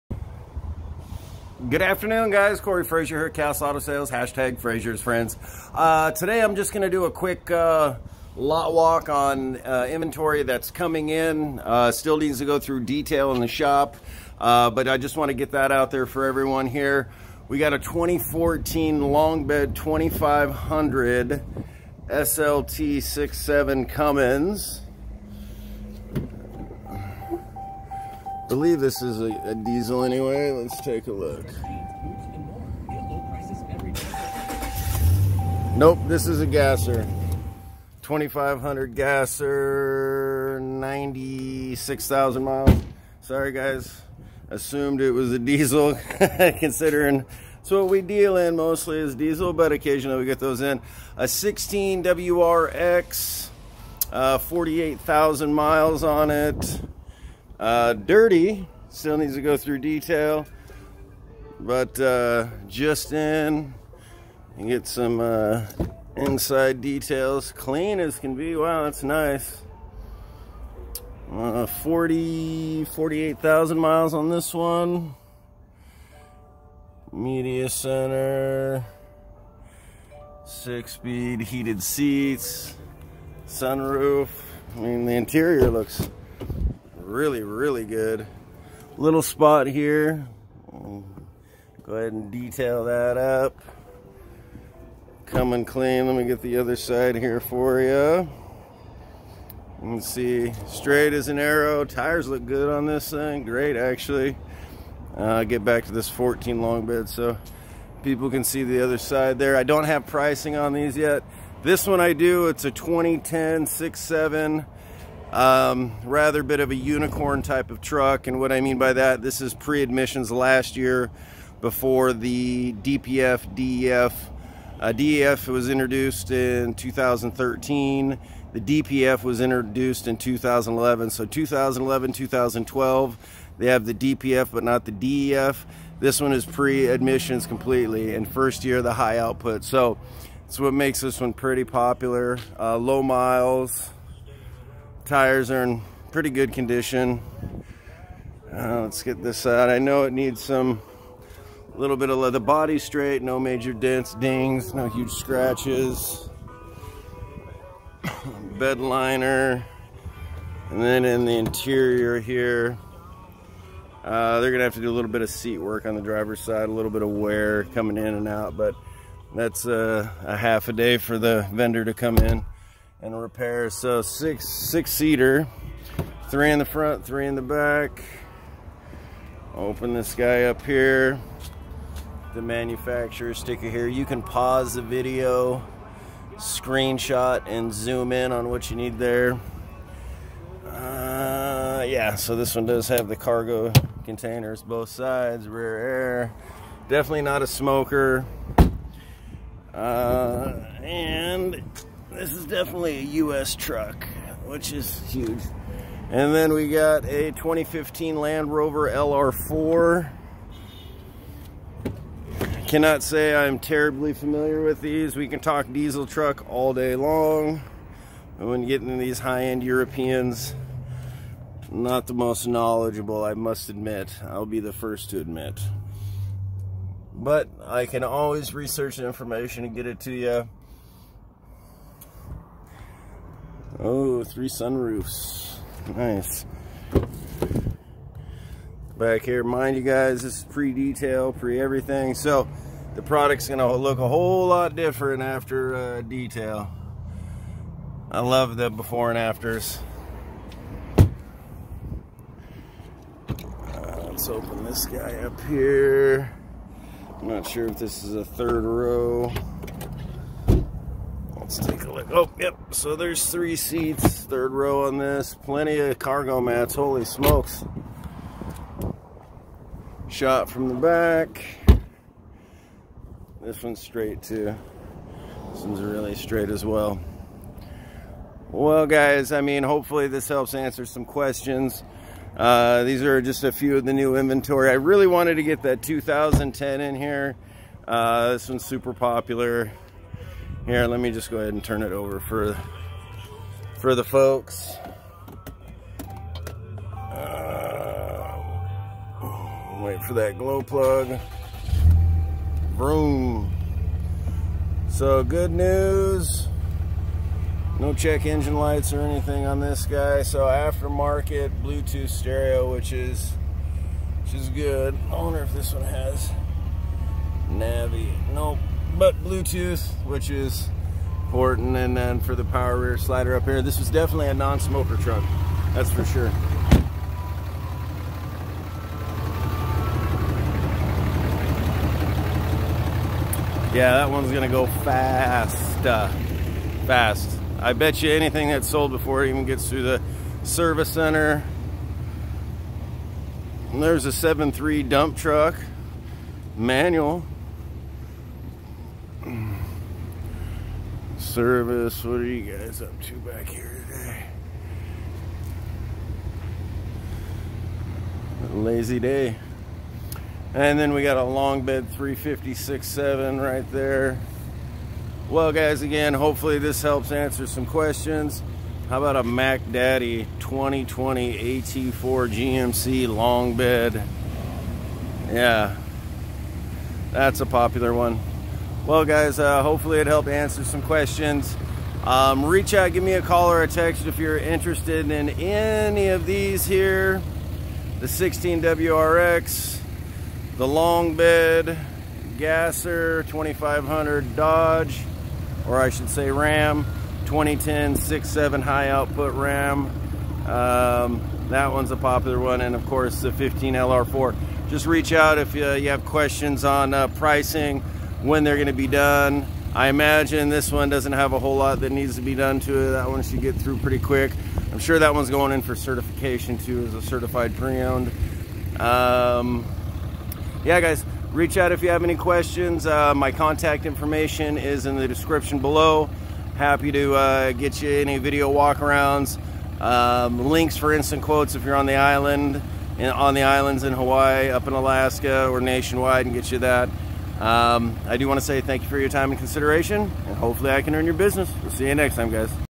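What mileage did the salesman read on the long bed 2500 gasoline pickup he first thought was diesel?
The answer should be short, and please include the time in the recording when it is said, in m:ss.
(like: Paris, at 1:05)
96,000 miles, at 0:40.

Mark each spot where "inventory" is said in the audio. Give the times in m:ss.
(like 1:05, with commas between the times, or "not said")
0:09, 4:44.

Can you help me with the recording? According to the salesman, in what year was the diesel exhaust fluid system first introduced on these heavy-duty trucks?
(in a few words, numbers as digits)
2013.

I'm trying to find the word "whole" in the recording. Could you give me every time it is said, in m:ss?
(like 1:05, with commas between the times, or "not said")
4:04, 6:51.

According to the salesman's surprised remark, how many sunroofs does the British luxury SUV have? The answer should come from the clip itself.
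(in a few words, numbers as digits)
3.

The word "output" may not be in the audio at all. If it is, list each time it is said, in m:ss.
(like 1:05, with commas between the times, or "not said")
2:19, 6:38.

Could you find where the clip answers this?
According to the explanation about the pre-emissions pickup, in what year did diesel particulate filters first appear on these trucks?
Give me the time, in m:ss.
2:08.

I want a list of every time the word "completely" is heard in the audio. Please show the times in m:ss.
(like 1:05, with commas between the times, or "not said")
2:17.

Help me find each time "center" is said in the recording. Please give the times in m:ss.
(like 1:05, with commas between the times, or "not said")
1:17, 5:40.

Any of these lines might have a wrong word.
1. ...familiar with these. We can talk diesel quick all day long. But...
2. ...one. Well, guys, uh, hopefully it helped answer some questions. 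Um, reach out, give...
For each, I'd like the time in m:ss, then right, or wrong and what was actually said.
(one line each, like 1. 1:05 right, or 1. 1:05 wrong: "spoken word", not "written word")
1. 3:34 wrong: "truck", not "quick"
2. 6:17 right.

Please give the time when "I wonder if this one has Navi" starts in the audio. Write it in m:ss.
5:15.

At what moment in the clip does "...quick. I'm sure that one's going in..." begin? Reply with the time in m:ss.
6:53.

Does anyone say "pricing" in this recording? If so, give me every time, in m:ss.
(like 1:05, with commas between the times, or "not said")
1:50, 6:47.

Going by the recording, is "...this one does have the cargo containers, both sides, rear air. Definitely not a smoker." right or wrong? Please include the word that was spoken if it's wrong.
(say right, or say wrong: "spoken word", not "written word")
right.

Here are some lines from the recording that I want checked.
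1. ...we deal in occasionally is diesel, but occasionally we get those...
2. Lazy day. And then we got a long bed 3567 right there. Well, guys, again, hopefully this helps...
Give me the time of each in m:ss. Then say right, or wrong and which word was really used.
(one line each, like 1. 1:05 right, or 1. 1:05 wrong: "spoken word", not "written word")
1. 0:47 wrong: "mostly", not "occasionally"
2. 5:58 right.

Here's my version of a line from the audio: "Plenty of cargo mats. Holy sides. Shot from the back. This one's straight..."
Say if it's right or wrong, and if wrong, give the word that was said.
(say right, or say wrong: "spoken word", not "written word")
wrong: "smokes", not "sides".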